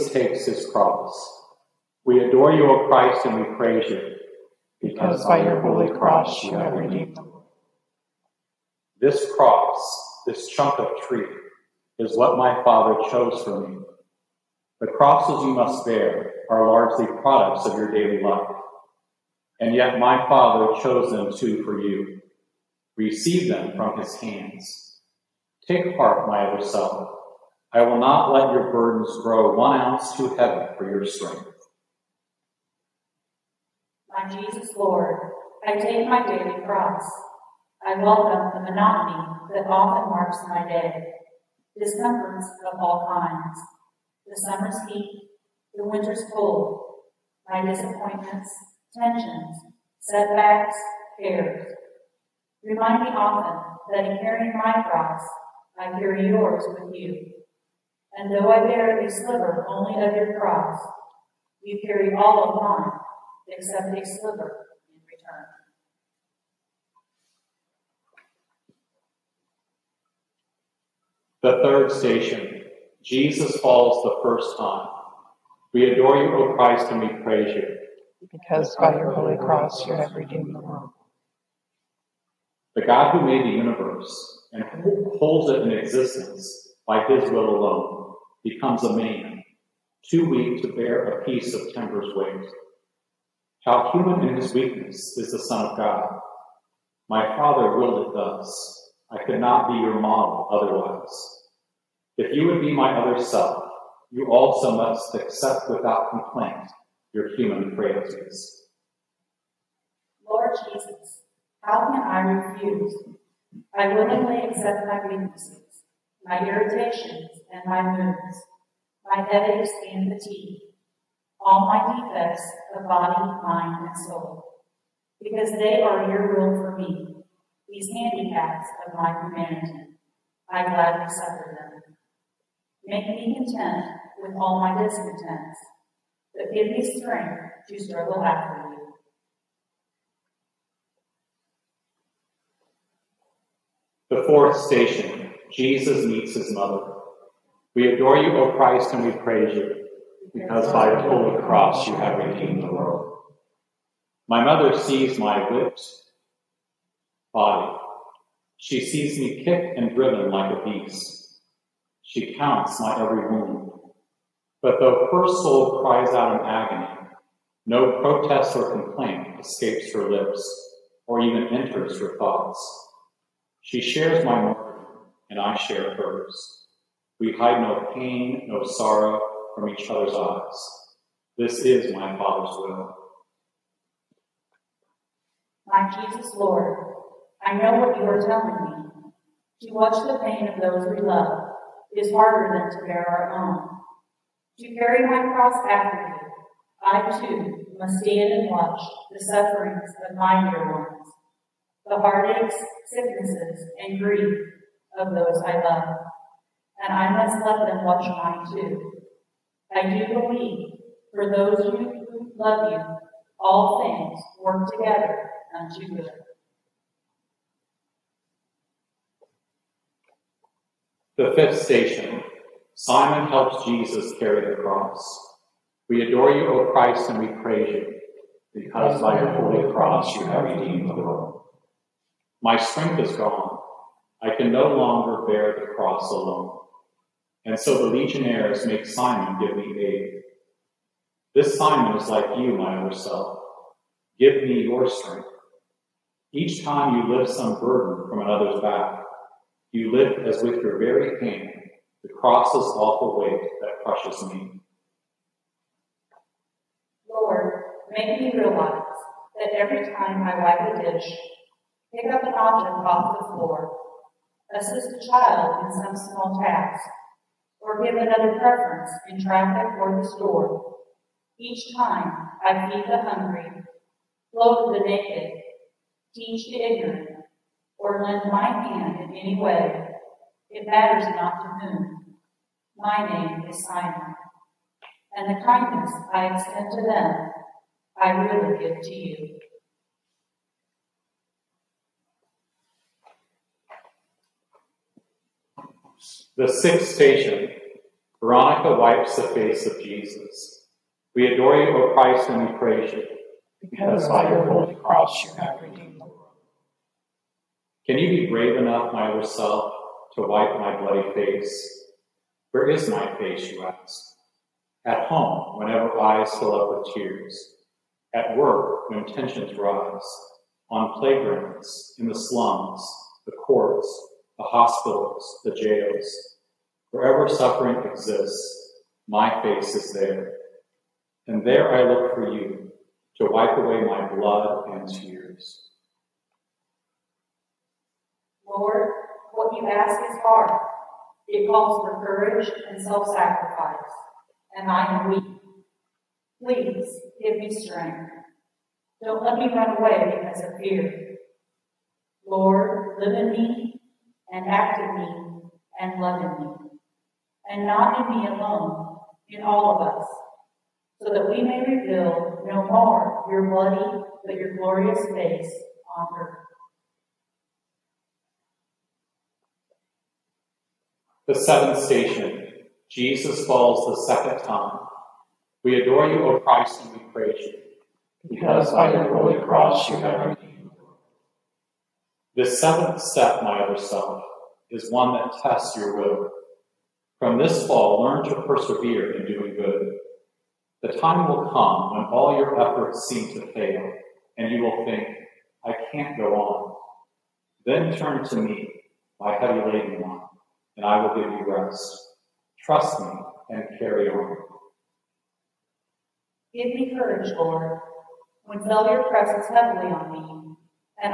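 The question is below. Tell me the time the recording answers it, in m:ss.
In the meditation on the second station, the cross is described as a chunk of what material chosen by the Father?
0:10.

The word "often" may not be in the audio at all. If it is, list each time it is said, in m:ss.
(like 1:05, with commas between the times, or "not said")
0:39, 0:53.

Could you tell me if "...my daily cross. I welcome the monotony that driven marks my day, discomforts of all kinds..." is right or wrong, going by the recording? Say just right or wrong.
wrong.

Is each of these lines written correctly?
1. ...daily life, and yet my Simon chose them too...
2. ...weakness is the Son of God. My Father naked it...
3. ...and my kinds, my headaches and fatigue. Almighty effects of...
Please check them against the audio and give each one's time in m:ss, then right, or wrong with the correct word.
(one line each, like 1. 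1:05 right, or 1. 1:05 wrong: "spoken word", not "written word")
1. 0:17 wrong: "Father", not "Simon"
2. 1:34 wrong: "willed", not "naked"
3. 1:57 wrong: "moods", not "kinds".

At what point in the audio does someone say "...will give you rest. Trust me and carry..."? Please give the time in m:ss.
6:41.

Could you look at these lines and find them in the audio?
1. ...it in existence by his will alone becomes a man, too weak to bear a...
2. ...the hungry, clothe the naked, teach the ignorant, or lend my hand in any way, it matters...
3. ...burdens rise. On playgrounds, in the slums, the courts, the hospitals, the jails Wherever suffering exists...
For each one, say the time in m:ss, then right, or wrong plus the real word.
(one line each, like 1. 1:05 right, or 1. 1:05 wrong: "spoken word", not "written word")
1. 1:25 right
2. 4:32 right
3. 5:19 wrong: "tensions", not "burdens".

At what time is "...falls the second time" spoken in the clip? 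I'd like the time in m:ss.
6:13.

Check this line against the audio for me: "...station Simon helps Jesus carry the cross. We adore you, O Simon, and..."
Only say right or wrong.
wrong.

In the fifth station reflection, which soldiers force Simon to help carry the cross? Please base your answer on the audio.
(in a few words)
The legionnaires.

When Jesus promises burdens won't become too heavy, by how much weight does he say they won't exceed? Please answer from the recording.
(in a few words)
One ounce.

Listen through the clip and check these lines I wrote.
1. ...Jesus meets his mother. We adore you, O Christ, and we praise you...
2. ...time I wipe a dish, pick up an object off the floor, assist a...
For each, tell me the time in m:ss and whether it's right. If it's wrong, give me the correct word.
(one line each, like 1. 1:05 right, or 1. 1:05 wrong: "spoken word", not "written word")
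1. 2:25 right
2. 4:19 right.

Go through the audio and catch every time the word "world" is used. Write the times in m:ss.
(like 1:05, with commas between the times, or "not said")
1:20, 2:32, 3:50, 5:06.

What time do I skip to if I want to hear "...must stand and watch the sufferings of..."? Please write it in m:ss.
3:17.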